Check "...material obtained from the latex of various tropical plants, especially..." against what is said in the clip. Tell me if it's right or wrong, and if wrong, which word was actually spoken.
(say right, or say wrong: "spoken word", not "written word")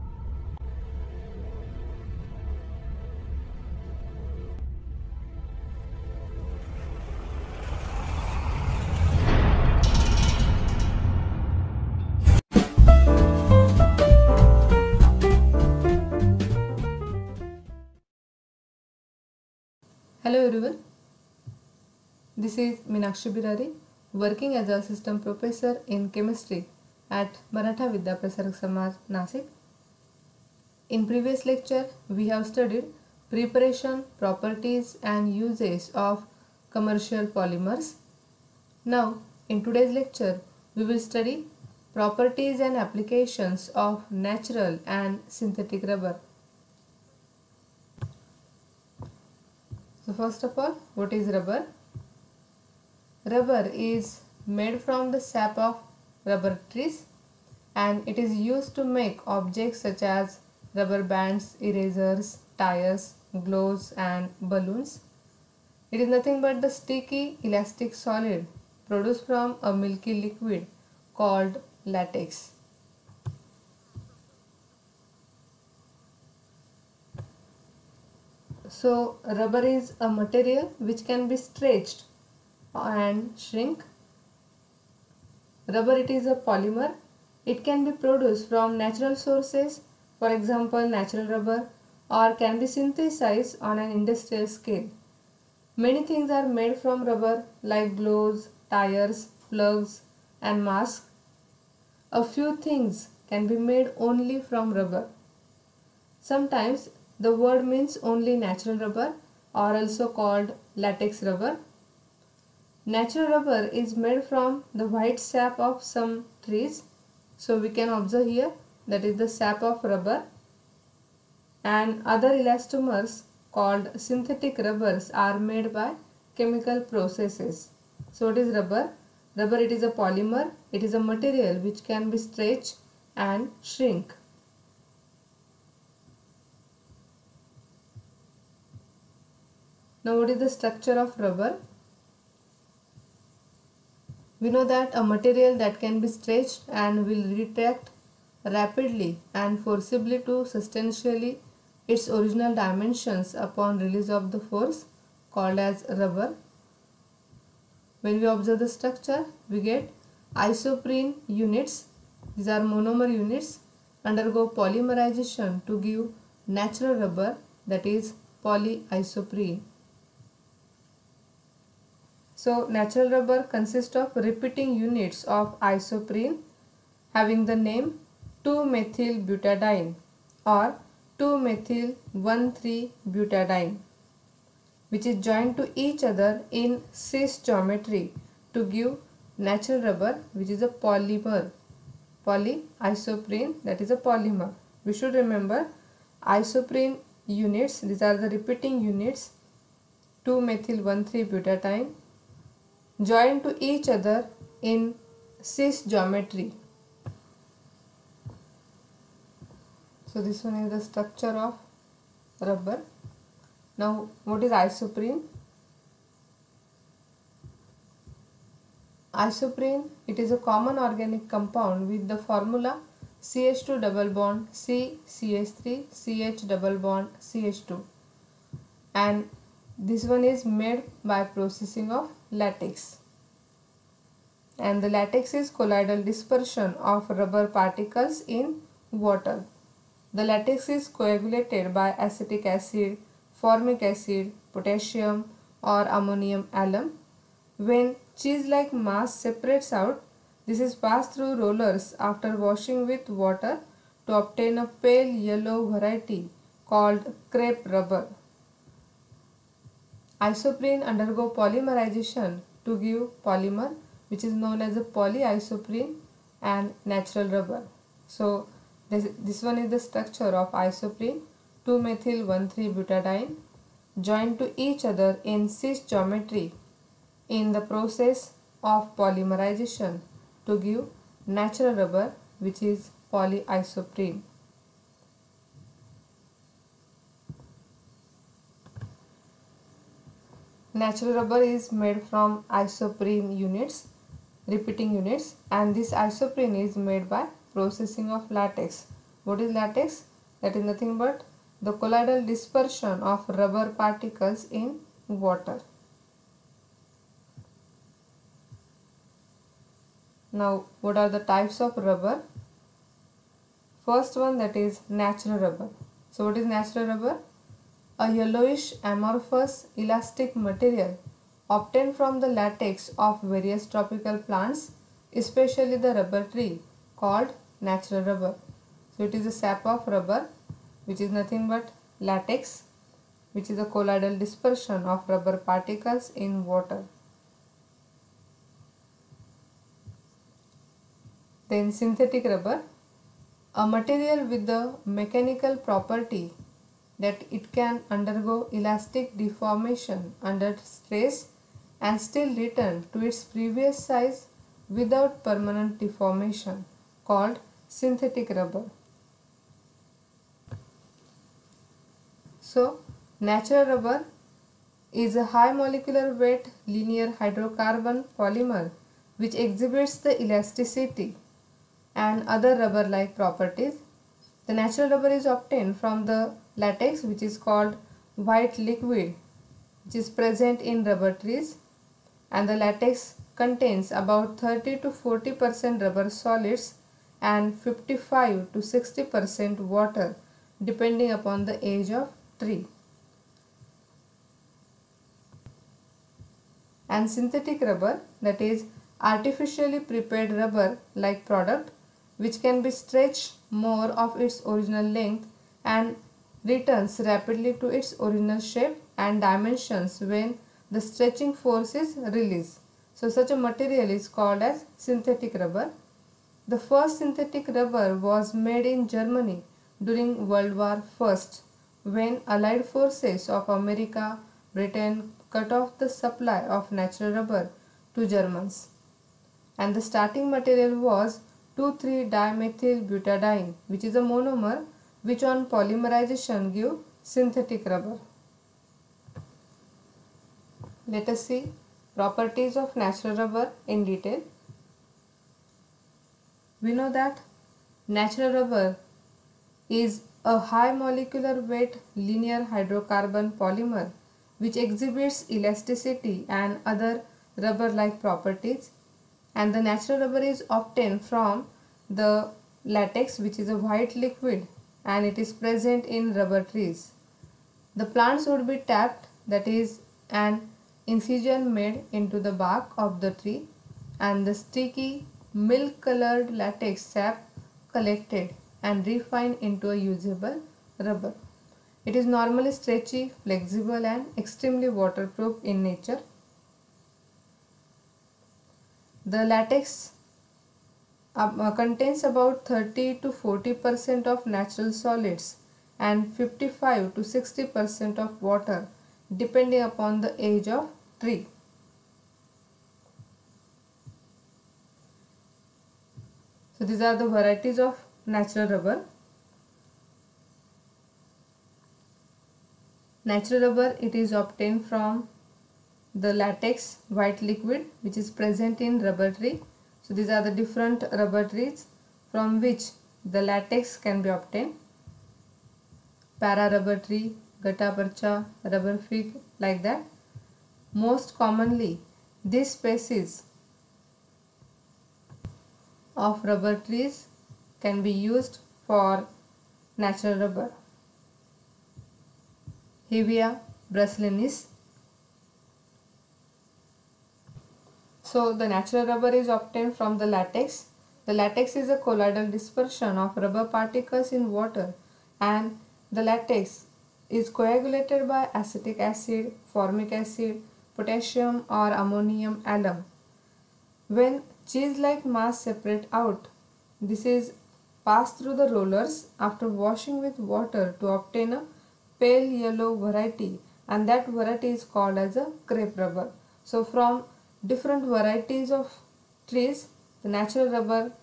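right.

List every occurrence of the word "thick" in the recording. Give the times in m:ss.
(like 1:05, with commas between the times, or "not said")
not said.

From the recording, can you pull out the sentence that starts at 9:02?
Hevea brasiliensis So the natural rubber is obtained from the latex.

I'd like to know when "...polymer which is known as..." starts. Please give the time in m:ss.
4:23.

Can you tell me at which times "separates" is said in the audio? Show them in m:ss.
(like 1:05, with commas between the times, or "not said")
4:09, 9:25.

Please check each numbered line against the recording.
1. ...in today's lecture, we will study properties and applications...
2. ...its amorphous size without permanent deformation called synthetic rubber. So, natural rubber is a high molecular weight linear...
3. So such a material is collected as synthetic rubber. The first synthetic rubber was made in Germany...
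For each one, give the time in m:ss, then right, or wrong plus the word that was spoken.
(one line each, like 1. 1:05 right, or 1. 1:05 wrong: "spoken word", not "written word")
1. 0:39 right
2. 5:53 wrong: "previous", not "amorphous"
3. 6:52 wrong: "called", not "collected".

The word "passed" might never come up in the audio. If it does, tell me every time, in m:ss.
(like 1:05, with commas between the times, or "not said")
4:10, 9:27.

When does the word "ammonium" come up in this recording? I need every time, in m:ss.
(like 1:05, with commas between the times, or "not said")
4:05, 9:21.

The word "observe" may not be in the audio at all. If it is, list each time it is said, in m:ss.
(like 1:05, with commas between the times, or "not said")
1:57, 2:38.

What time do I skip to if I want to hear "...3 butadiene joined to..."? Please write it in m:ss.
3:21.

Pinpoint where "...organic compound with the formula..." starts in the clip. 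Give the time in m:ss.
3:40.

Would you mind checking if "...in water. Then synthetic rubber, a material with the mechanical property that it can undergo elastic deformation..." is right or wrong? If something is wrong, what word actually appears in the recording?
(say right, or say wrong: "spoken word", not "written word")
right.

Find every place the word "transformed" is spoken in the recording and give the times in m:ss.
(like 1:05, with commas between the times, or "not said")
not said.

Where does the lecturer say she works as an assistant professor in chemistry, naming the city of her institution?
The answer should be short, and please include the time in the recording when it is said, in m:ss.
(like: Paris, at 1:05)
Nasik, at 0:29.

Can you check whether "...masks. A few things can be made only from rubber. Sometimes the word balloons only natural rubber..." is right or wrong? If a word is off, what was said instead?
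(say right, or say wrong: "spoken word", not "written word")
wrong: "means", not "balloons".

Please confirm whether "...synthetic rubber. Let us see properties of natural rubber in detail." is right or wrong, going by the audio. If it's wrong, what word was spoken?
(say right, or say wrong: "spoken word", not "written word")
right.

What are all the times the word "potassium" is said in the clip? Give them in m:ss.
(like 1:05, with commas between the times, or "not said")
4:04, 9:20.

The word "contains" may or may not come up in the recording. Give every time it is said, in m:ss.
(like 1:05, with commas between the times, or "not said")
6:23, 8:11.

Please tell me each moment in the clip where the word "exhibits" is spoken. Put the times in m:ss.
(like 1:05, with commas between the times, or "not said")
6:09, 7:34.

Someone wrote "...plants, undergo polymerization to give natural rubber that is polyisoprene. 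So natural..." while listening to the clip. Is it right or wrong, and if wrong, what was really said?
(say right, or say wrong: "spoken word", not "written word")
wrong: "units", not "plants".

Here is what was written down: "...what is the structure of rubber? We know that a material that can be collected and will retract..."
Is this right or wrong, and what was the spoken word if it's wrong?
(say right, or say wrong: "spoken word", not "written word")
wrong: "stretched", not "collected".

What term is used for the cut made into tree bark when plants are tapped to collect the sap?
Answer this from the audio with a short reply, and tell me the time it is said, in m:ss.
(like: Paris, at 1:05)
incision, at 7:50.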